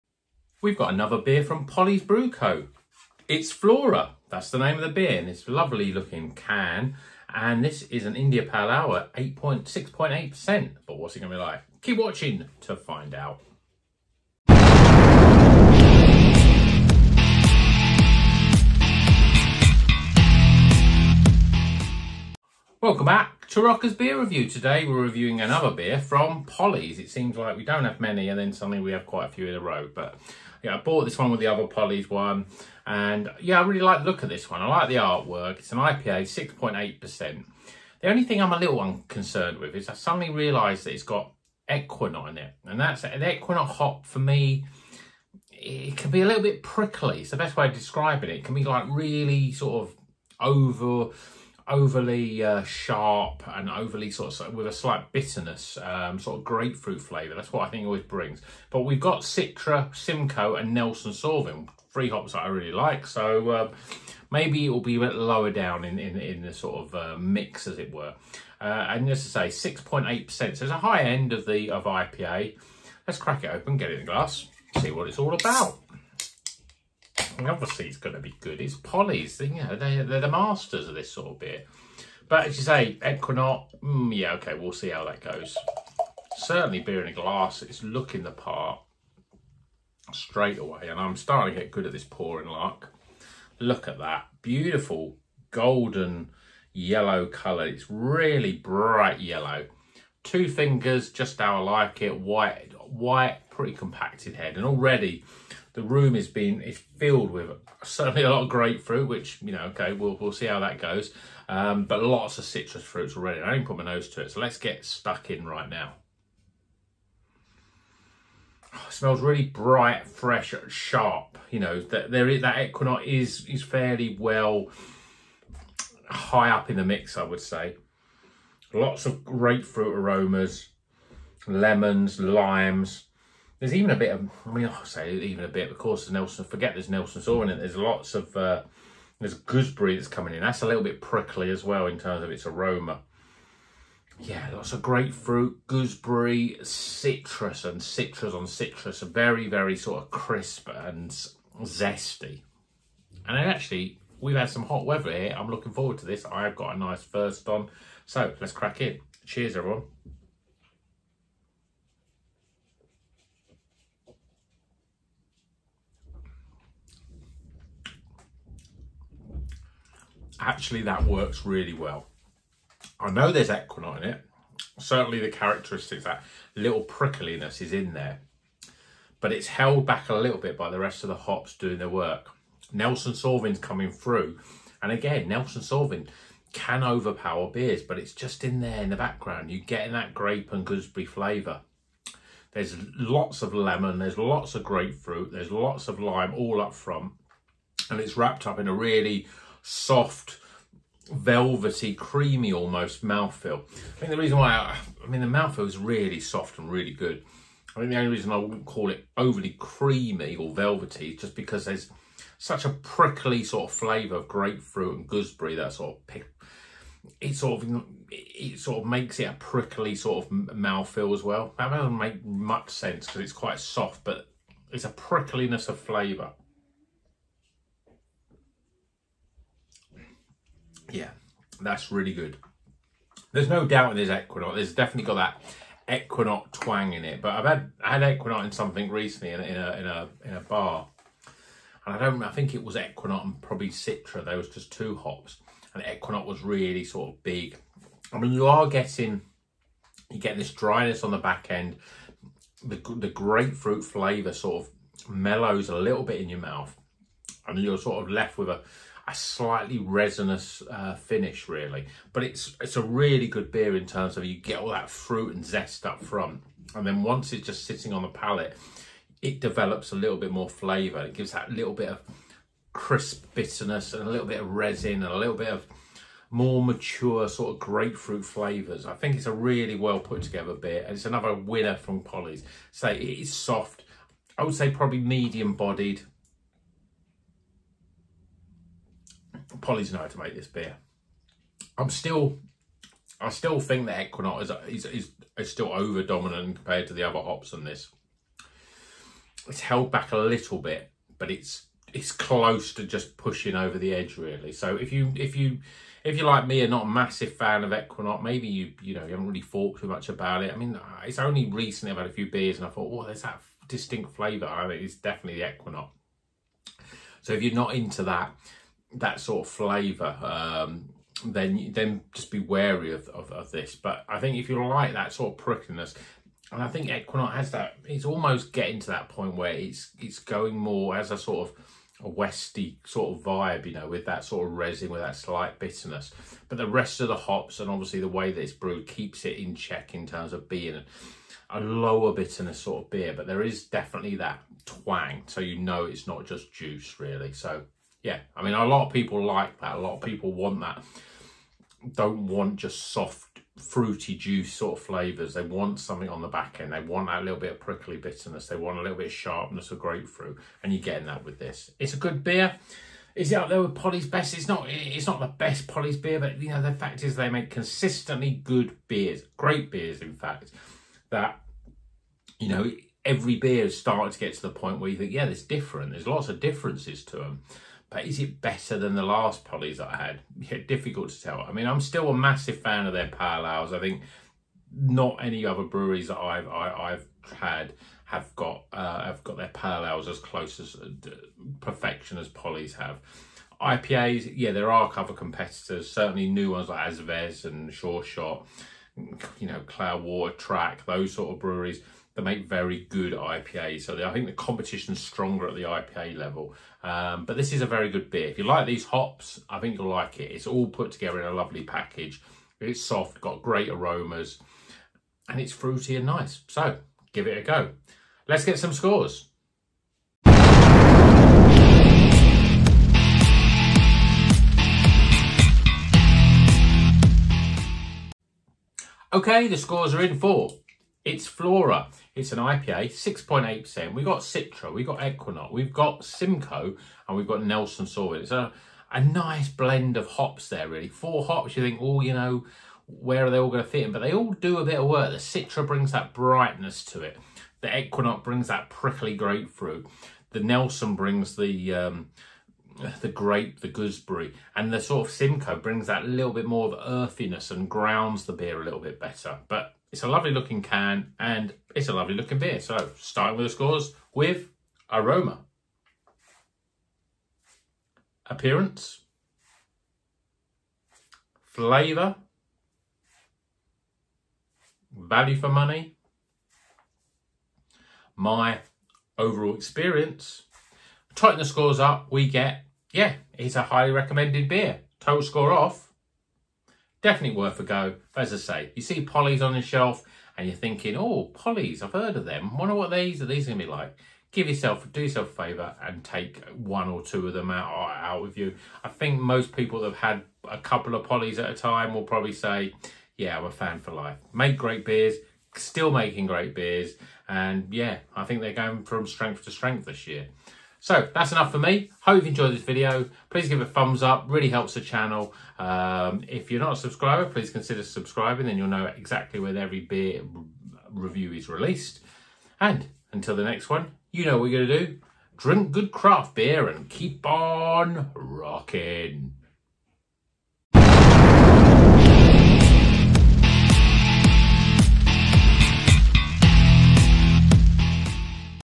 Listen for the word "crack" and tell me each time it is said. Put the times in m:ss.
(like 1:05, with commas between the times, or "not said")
1:13, 2:38.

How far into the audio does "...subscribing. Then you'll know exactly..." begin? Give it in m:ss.
8:37.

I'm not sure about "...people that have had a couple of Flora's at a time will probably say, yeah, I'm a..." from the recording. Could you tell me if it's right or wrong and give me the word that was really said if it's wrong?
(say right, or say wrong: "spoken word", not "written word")
wrong: "Polly", not "Flora".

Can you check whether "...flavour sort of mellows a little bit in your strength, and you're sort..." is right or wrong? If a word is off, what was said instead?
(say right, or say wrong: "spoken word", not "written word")
wrong: "mouth", not "strength".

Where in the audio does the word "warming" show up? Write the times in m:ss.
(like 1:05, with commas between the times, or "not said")
not said.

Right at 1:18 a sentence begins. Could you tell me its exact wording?
It's Polly's, you know, they, they're the masters of this sort of beer.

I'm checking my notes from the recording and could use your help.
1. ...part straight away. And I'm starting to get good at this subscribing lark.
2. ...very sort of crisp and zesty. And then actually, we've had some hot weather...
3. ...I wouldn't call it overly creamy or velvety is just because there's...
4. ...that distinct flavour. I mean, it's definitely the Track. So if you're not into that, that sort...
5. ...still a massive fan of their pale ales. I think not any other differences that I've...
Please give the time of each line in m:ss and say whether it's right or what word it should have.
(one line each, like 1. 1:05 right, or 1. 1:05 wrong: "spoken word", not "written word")
1. 1:28 wrong: "pouring", not "subscribing"
2. 2:29 right
3. 3:28 right
4. 5:13 wrong: "Equinox", not "Track"
5. 6:21 wrong: "breweries", not "differences".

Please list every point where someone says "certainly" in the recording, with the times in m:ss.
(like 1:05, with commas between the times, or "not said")
1:26, 1:47, 2:54, 6:35.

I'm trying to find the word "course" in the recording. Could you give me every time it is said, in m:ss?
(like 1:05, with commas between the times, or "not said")
2:15.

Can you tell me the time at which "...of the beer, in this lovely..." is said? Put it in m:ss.
0:04.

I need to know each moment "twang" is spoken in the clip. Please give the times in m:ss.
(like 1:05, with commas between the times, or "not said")
3:56, 5:44.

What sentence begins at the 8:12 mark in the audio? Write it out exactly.
Wonder what these are these going to be like.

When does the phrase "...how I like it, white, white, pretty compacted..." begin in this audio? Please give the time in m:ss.
1:41.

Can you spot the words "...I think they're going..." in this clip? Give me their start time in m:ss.
8:28.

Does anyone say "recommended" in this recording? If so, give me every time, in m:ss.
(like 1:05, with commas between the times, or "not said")
8:03.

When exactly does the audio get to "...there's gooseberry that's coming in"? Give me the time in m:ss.
2:19.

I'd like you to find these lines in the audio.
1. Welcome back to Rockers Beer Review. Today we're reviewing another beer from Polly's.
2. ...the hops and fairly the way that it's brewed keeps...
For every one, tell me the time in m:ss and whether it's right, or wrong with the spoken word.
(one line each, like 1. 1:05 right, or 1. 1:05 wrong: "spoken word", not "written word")
1. 0:22 right
2. 5:37 wrong: "obviously", not "fairly".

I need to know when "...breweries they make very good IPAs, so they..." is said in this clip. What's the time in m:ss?
6:41.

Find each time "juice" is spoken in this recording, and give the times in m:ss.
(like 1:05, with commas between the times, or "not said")
5:46, 5:54.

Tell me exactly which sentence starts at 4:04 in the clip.
Those just two hops, and Equinox was really sort of big.